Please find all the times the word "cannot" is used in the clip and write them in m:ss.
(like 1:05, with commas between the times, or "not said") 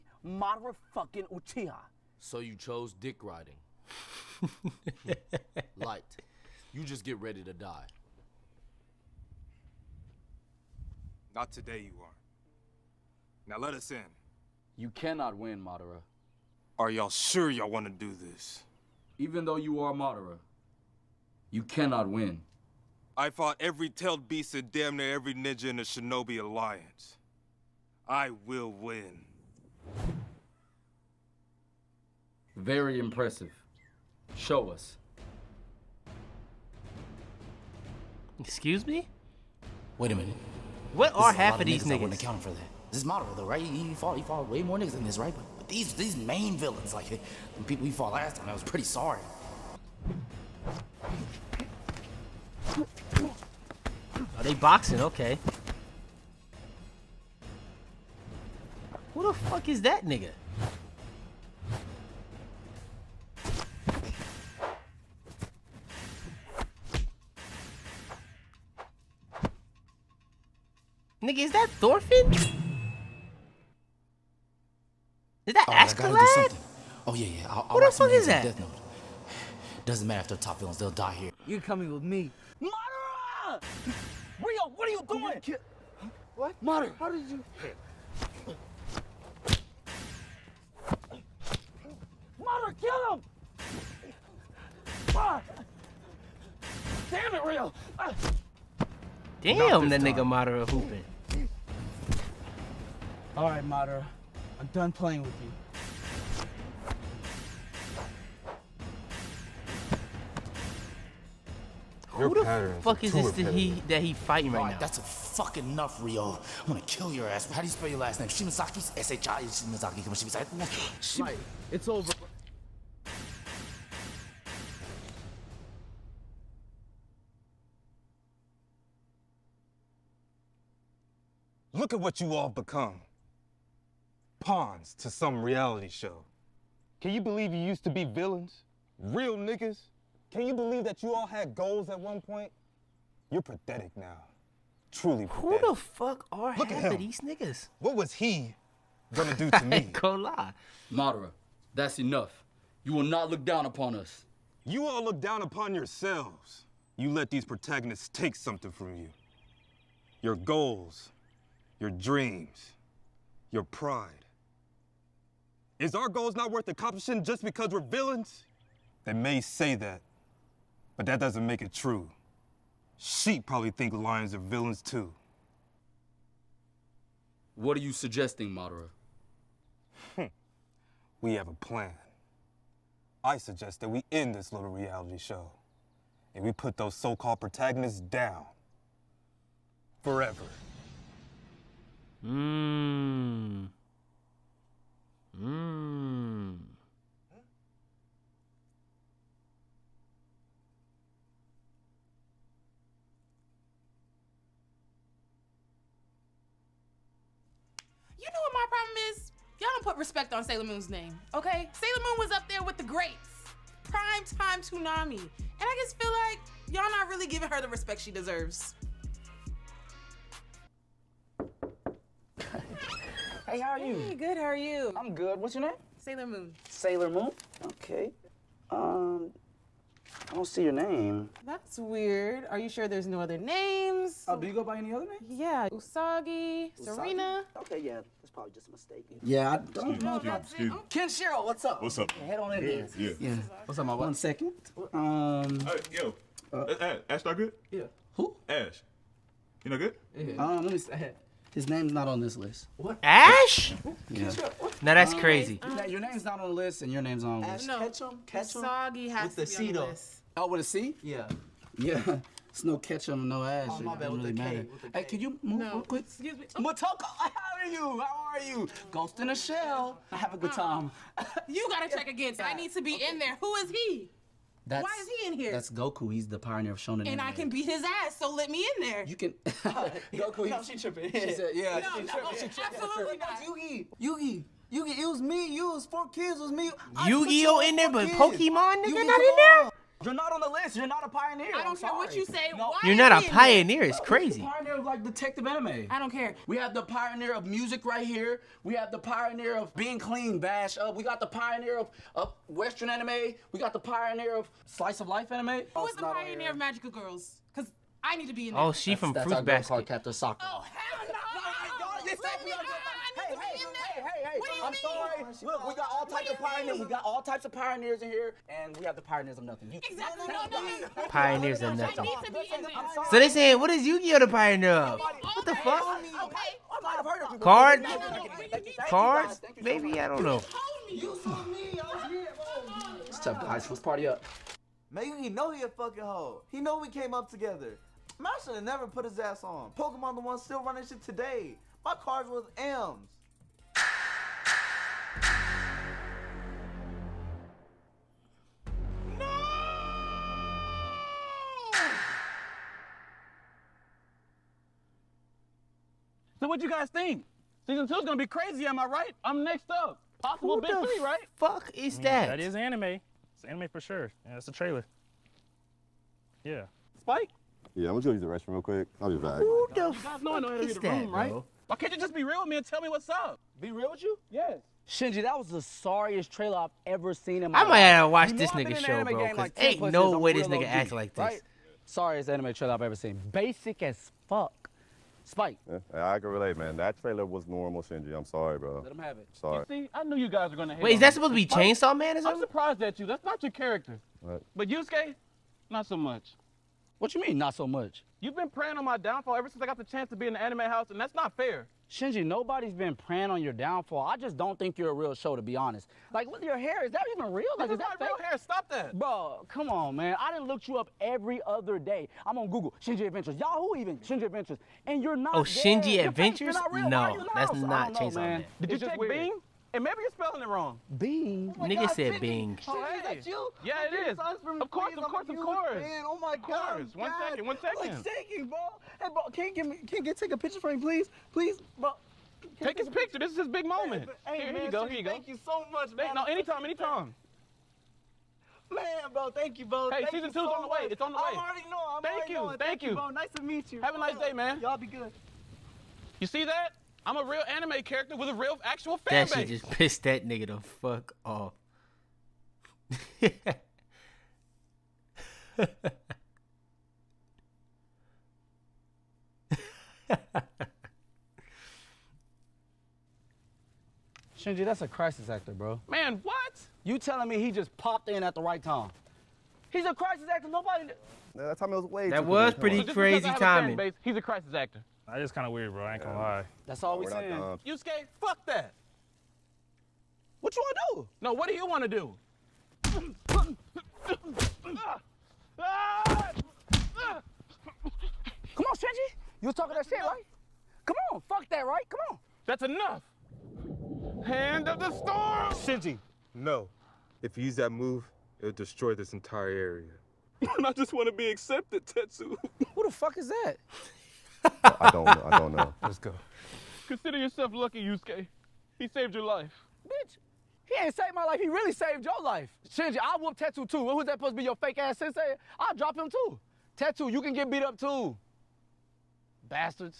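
0:14, 0:21.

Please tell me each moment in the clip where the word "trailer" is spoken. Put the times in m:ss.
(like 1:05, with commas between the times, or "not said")
6:04, 6:16, 6:22, 6:26.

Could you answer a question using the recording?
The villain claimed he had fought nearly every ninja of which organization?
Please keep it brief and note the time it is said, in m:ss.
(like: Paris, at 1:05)
Shinobi Alliance, at 0:25.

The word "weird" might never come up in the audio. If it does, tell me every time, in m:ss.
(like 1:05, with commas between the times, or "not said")
3:51, 7:55.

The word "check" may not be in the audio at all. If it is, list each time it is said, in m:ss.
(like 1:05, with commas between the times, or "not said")
4:31, 6:58.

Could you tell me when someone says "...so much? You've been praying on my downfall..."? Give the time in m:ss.
6:37.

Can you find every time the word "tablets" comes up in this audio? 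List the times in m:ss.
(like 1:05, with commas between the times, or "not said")
not said.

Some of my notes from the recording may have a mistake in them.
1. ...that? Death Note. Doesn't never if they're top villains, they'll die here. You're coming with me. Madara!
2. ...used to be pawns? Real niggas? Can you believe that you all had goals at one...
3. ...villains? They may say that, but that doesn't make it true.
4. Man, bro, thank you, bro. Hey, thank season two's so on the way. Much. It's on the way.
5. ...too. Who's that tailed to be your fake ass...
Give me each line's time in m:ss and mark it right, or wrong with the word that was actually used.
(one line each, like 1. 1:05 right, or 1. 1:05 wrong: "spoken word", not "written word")
1. 1:18 wrong: "matter", not "never"
2. 2:17 wrong: "villains", not "pawns"
3. 2:47 right
4. 7:18 right
5. 8:33 wrong: "supposed", not "tailed".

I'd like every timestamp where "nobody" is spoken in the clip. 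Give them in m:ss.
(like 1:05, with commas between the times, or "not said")
6:42, 7:50.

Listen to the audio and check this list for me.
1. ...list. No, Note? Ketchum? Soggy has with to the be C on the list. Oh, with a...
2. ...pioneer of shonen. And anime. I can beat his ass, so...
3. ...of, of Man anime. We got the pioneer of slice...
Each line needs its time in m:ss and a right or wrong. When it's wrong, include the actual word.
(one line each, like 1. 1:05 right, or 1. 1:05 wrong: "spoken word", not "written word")
1. 4:17 wrong: "Ketchum", not "Note"
2. 4:36 right
3. 5:01 wrong: "Western", not "Man".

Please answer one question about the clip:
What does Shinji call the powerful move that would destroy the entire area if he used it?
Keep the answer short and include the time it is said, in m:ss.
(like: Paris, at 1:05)
Hand of the storm, at 8:14.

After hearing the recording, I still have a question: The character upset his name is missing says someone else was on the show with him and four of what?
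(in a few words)
Kids.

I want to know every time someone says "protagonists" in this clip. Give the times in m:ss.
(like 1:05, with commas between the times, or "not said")
2:37, 3:07.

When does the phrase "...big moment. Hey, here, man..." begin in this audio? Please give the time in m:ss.
7:13.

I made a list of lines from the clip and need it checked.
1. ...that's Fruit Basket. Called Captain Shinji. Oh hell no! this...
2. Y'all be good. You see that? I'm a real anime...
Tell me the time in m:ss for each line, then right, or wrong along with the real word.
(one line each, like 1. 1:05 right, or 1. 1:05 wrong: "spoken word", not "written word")
1. 5:09 wrong: "Soccer", not "Shinji"
2. 7:24 right.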